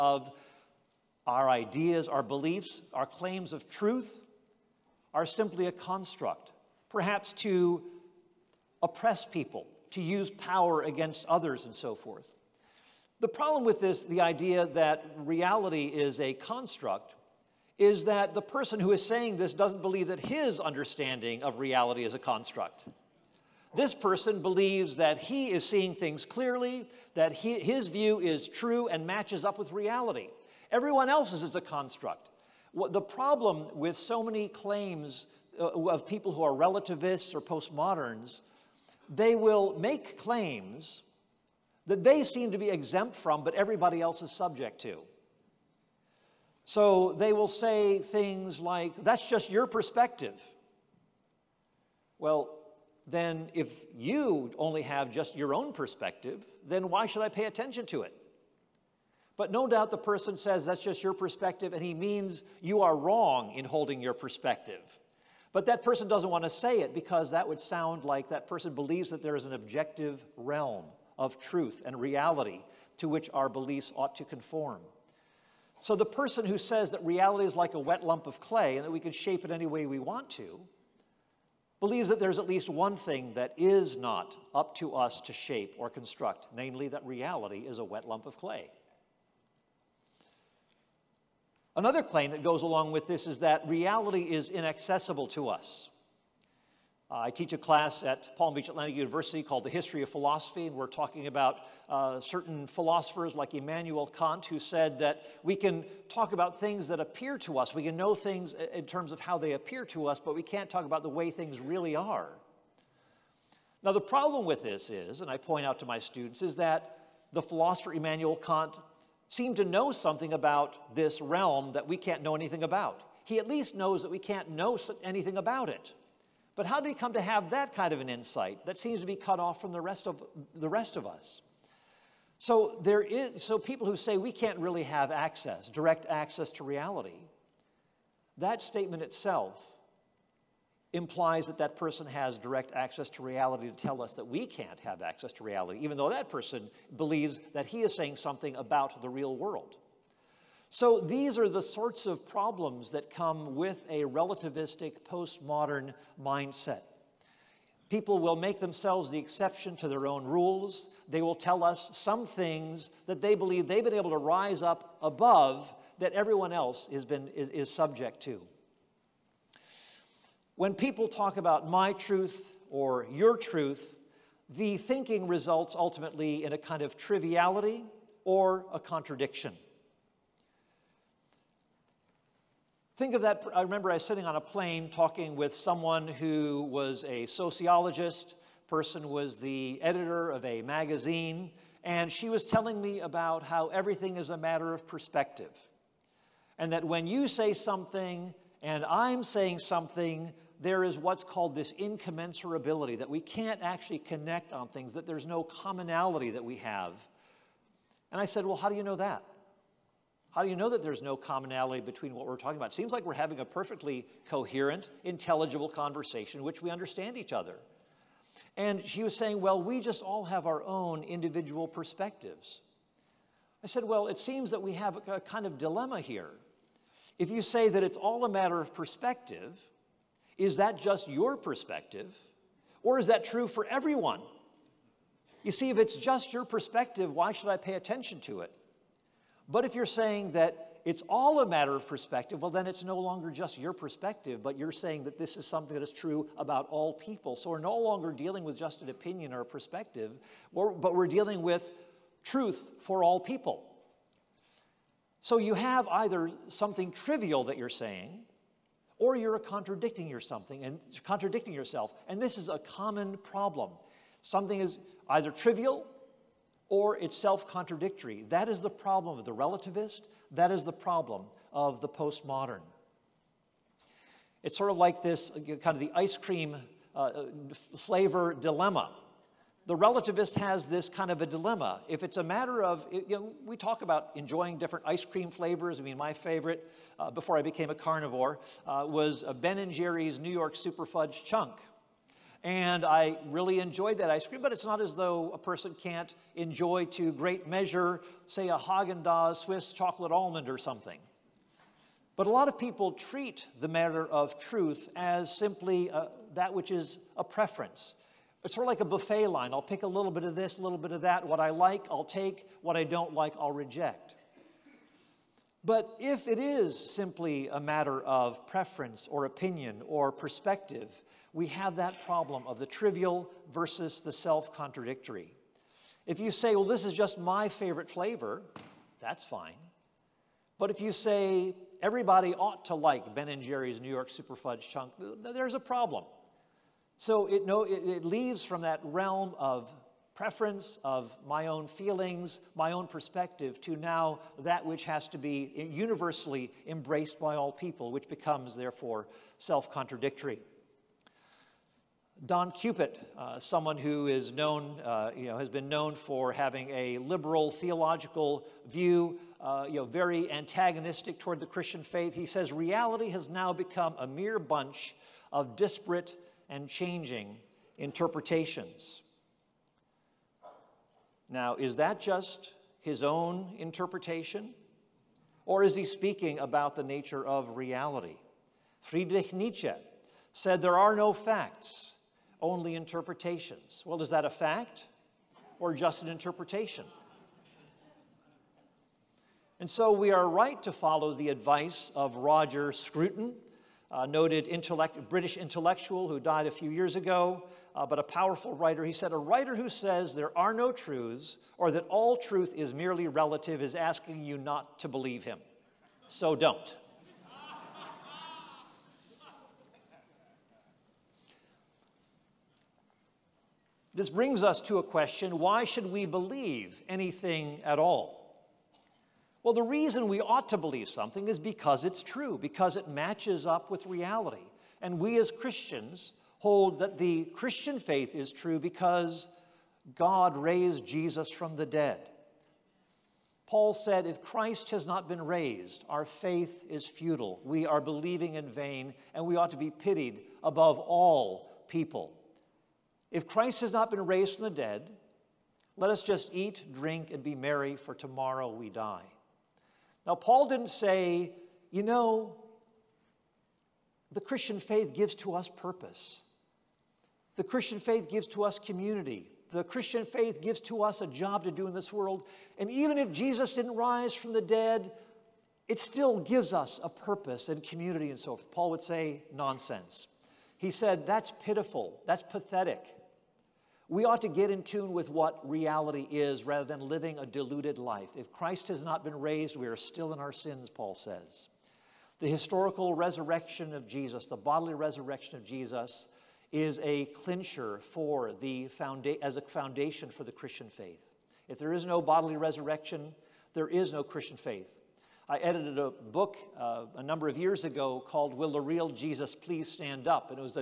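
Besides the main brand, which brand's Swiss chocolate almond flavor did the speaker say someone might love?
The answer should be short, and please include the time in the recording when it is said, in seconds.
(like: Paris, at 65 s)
Haagen-Dazs, at 298 s.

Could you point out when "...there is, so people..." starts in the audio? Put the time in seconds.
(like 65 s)
132 s.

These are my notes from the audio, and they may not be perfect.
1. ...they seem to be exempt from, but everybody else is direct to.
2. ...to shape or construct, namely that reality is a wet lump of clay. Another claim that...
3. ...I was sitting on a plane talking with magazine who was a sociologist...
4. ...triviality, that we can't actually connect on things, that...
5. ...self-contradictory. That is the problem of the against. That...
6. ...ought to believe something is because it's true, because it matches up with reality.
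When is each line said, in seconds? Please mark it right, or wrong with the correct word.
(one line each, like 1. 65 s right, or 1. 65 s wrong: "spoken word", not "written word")
1. 42 s wrong: "subject", not "direct"
2. 85 s right
3. 183 s wrong: "someone", not "magazine"
4. 201 s wrong: "incommensurability", not "triviality"
5. 267 s wrong: "relativist", not "against"
6. 420 s right.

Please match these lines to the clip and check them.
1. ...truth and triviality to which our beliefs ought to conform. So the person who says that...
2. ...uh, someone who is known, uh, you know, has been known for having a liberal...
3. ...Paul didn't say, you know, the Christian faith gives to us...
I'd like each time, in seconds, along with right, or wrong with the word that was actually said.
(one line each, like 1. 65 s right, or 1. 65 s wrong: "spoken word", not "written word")
1. 71 s wrong: "reality", not "triviality"
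2. 353 s right
3. 450 s right.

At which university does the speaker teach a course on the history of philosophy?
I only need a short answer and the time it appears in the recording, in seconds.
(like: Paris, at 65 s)
Palm Beach Atlantic University, at 98 s.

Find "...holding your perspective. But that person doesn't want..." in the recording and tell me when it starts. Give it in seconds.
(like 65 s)
63 s.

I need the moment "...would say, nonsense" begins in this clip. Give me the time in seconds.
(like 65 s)
468 s.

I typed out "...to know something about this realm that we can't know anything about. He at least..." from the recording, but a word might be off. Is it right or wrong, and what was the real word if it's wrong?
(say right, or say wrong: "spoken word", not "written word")
right.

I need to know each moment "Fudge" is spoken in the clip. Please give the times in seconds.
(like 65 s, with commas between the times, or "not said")
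290 s, 334 s.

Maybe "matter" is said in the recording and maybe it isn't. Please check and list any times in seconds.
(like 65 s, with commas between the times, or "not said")
194 s, 228 s, 241 s, 282 s, 303 s, 317 s.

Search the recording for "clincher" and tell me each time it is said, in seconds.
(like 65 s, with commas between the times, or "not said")
487 s.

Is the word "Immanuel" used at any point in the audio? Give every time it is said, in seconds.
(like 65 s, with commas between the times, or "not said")
103 s, 117 s.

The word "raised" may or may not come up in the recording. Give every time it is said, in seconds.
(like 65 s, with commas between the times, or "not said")
430 s, 435 s, 444 s, 479 s.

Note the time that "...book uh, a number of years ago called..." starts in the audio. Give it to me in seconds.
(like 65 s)
495 s.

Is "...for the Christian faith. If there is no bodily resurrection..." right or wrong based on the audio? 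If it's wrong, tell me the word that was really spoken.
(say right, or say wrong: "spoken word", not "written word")
right.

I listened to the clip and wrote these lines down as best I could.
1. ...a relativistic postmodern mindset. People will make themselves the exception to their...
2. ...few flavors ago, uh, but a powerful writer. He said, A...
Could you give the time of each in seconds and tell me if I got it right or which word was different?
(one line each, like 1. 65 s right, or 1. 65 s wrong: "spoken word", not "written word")
1. 153 s right
2. 396 s wrong: "years", not "flavors".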